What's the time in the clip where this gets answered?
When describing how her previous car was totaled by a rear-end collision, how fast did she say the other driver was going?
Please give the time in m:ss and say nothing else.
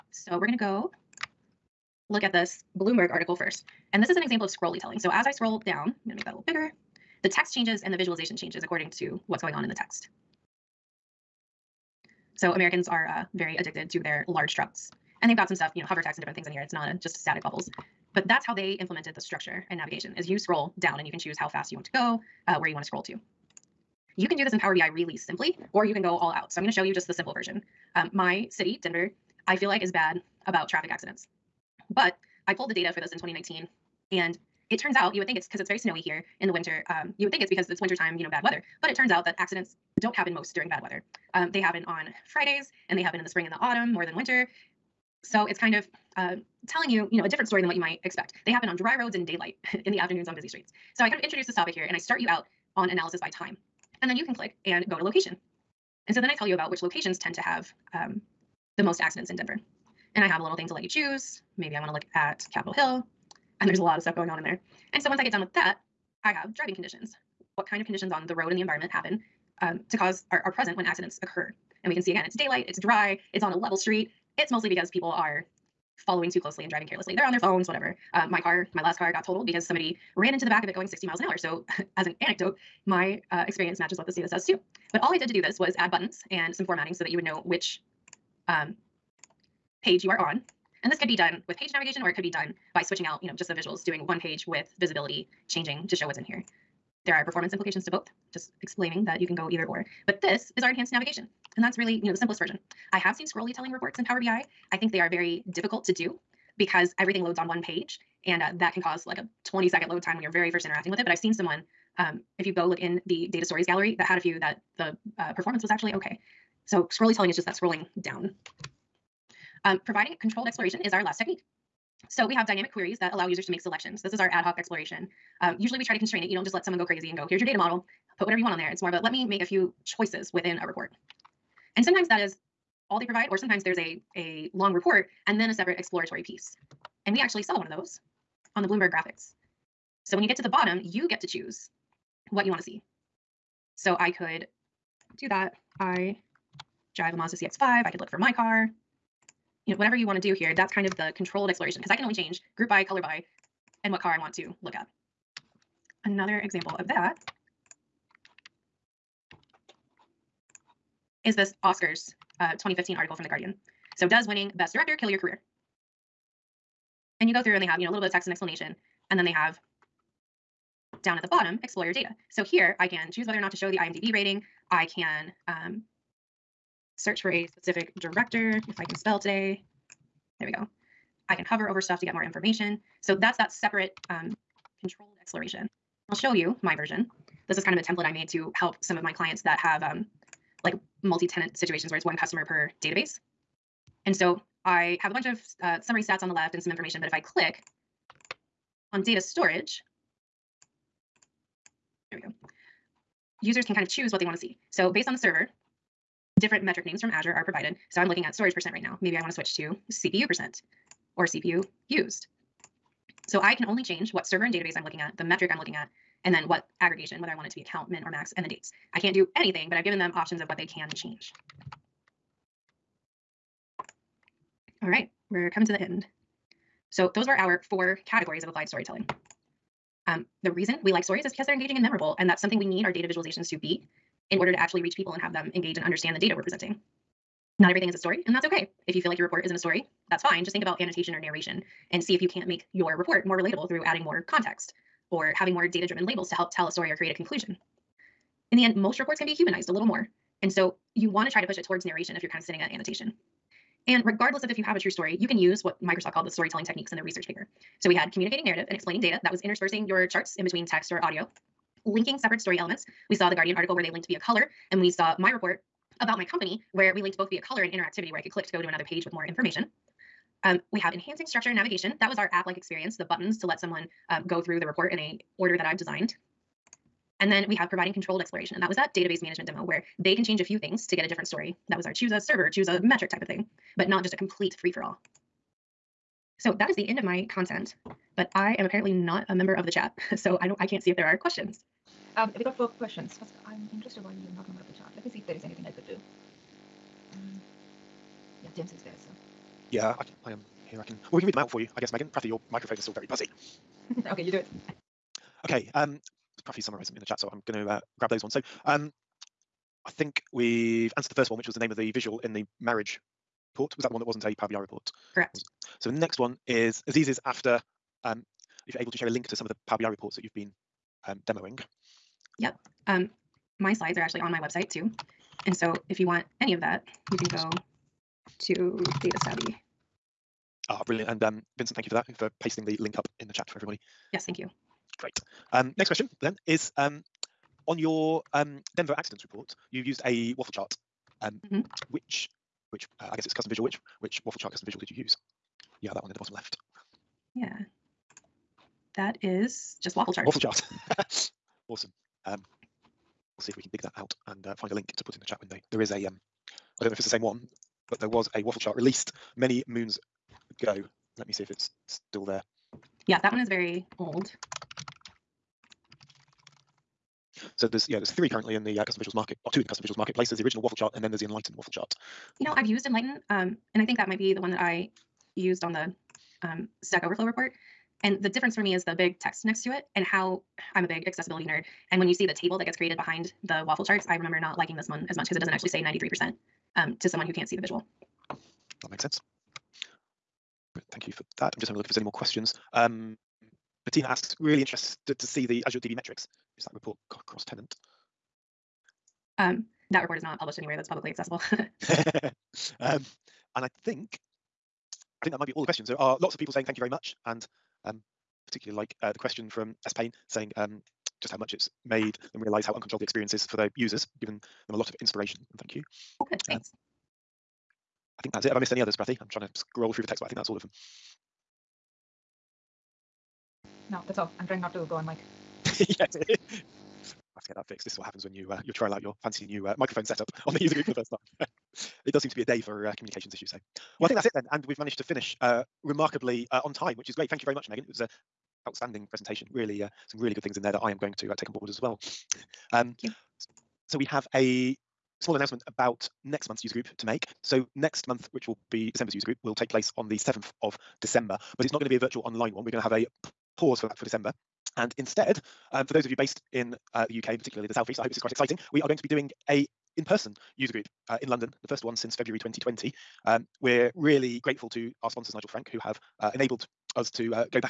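1:20.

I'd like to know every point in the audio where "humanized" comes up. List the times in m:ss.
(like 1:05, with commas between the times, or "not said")
4:09.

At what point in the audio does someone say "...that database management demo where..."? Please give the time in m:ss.
4:38.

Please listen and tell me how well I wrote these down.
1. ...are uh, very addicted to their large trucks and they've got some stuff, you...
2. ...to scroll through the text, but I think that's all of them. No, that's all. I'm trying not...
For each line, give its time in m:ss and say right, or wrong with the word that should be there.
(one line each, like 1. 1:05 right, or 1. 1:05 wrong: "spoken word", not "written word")
1. 0:12 right
2. 6:59 right.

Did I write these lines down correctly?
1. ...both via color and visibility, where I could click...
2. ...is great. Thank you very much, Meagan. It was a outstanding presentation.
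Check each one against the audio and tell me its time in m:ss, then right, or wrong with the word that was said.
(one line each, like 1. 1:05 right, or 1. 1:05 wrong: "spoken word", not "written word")
1. 4:27 wrong: "interactivity", not "visibility"
2. 7:17 right.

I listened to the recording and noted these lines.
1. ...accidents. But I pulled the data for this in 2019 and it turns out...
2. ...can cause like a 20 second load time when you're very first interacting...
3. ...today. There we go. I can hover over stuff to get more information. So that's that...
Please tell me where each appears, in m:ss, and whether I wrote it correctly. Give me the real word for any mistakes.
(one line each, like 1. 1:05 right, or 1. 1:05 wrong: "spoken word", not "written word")
1. 0:30 right
2. 1:48 right
3. 2:59 right.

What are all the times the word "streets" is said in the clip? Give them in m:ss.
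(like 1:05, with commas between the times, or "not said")
0:50, 1:13.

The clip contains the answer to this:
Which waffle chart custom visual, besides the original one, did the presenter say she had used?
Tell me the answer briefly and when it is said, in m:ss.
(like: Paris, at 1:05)
Enlighten, at 6:12.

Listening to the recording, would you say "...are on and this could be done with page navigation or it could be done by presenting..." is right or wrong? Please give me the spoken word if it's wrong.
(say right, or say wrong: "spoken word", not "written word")
wrong: "switching", not "presenting".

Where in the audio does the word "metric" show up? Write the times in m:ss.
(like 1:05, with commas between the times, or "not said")
3:26, 3:35, 4:42, 6:35.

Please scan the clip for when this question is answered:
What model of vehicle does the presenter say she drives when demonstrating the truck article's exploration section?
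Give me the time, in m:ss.
2:27.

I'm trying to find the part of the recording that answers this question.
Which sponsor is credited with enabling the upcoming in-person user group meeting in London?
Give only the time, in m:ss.
7:45.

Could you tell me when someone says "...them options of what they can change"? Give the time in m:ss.
3:39.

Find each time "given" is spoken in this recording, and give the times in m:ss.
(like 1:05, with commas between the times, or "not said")
3:39, 6:54.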